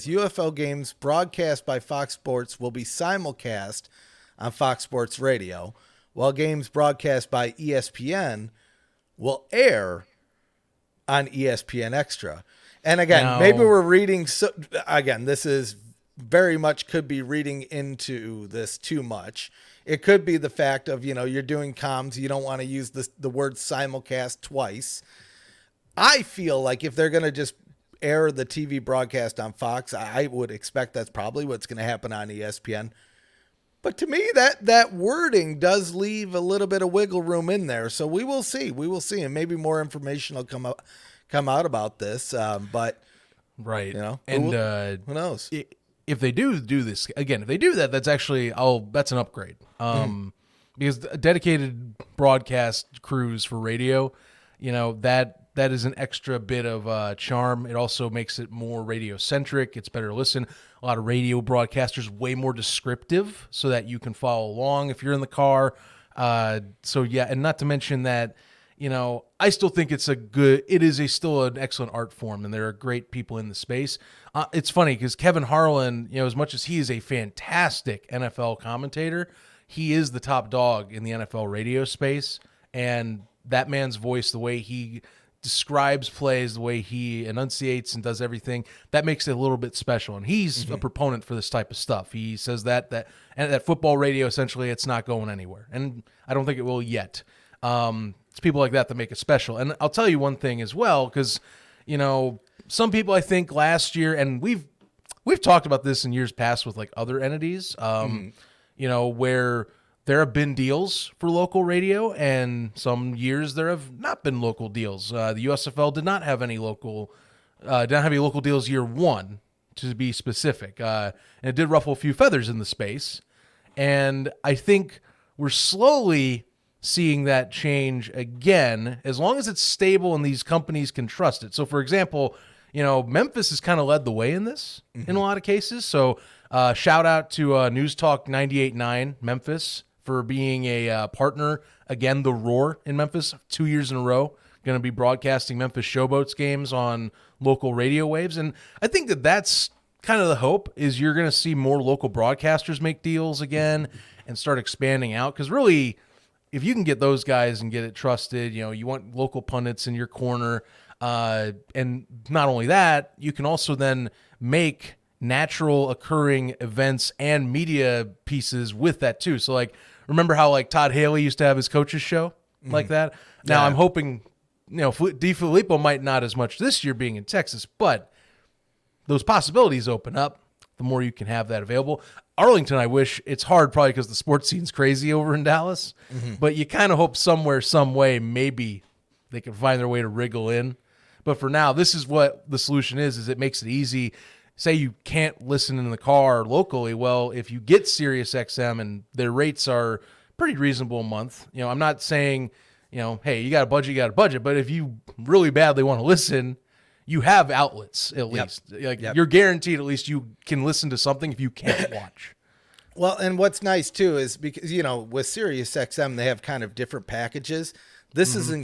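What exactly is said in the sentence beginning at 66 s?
Uh, so yeah, and not to mention that you know I still think it's a good.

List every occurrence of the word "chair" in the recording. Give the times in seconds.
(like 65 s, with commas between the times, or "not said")
not said.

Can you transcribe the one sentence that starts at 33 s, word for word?
But to me, that that wording does leave a little bit of wiggle room in there.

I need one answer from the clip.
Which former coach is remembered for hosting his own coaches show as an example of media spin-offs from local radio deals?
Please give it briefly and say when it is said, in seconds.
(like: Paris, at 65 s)
Todd Haley, at 170 s.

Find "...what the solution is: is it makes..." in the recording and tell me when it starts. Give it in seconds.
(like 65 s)
192 s.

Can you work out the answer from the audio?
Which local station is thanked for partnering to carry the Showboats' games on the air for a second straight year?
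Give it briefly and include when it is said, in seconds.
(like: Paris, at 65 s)
News Talk 98.9 Memphis, at 137 s.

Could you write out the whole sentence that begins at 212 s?
Well, and what's nice too is because you know with SiriusXM they have kind of different packages.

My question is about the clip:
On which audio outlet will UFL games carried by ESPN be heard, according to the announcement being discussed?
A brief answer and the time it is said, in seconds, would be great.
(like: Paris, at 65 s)
ESPN Extra, at 11 s.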